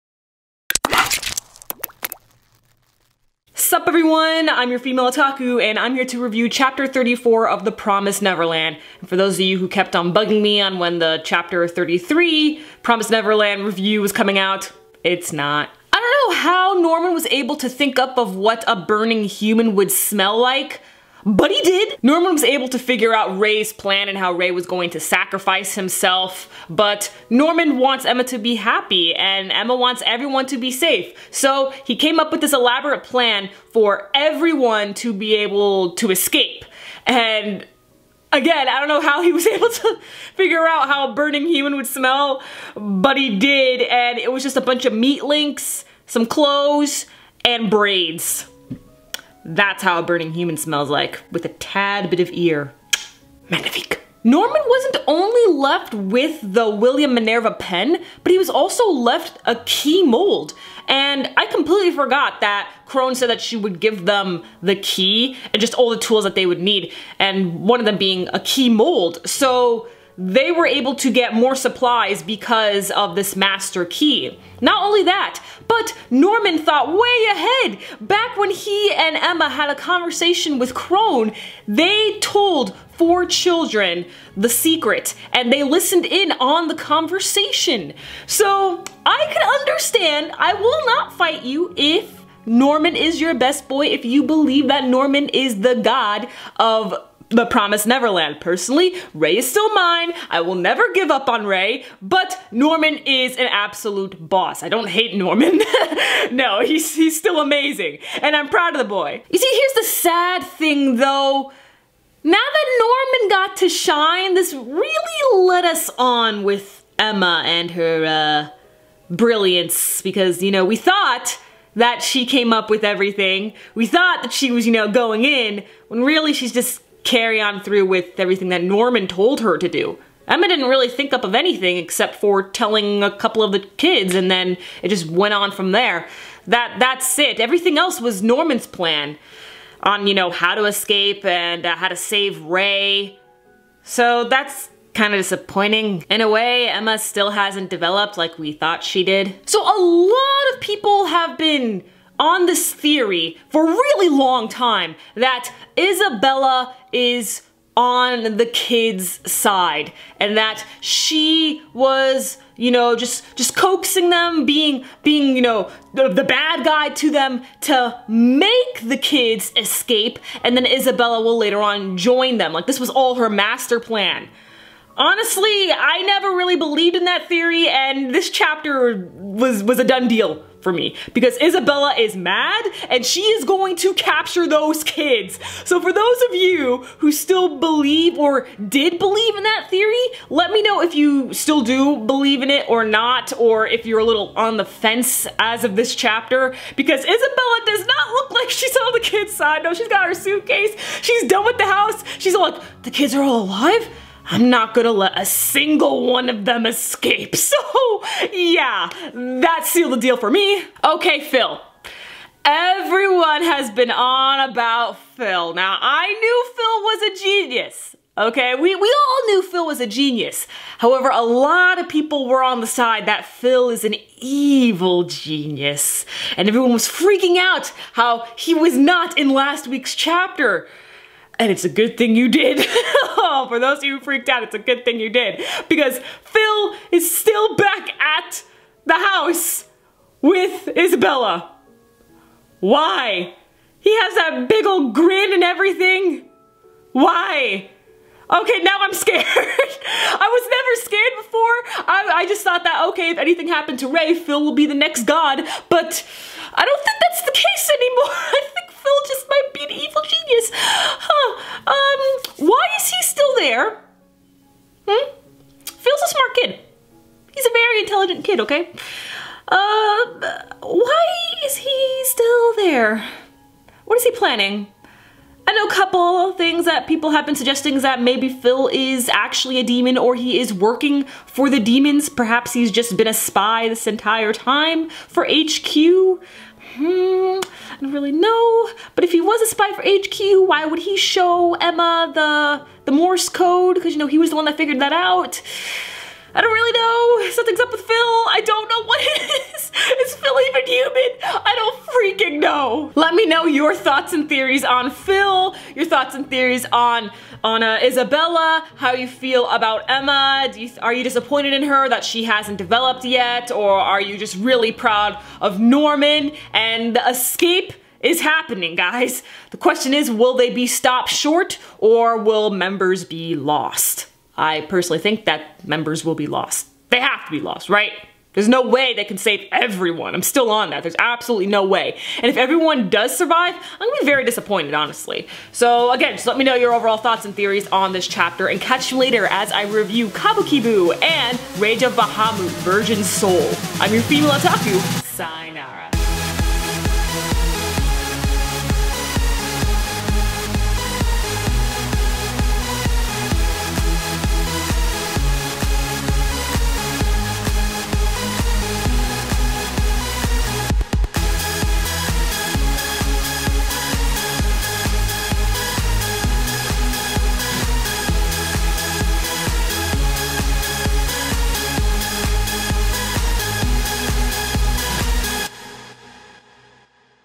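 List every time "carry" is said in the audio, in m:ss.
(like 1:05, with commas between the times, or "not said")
2:07.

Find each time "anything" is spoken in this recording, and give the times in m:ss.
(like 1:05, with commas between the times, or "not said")
2:11, 4:13.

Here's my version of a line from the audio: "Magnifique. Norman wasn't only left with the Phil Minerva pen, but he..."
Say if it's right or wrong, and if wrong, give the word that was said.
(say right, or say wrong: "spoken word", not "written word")
wrong: "William", not "Phil".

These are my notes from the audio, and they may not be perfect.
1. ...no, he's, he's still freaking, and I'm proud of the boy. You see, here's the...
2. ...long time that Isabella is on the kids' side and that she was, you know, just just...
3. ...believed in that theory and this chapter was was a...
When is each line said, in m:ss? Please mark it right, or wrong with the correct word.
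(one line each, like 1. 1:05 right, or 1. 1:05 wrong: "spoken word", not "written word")
1. 1:46 wrong: "amazing", not "freaking"
2. 2:34 right
3. 2:56 right.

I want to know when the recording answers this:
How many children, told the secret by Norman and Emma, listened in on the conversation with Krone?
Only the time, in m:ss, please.
1:22.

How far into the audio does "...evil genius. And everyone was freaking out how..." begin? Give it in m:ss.
3:44.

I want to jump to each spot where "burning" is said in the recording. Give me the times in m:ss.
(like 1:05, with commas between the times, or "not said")
0:18, 0:41, 0:50.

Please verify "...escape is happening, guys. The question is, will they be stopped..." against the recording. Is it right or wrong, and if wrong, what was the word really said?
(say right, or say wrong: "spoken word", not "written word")
right.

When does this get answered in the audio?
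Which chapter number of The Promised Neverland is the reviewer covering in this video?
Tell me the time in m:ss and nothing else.
0:06.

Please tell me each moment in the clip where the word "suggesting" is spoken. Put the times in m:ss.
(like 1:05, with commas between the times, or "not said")
4:37.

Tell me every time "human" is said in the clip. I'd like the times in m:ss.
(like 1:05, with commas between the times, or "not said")
0:19, 0:41, 0:50, 5:00.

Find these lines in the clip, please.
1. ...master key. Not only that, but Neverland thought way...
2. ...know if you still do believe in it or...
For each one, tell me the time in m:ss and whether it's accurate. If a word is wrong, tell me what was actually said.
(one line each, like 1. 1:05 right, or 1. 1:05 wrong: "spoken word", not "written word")
1. 1:13 wrong: "Norman", not "Neverland"
2. 3:10 right.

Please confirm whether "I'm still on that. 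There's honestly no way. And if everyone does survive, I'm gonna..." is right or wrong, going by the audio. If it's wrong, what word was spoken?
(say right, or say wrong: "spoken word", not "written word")
wrong: "absolutely", not "honestly".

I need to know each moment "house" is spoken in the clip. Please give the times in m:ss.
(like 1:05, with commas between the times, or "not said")
3:21, 3:58.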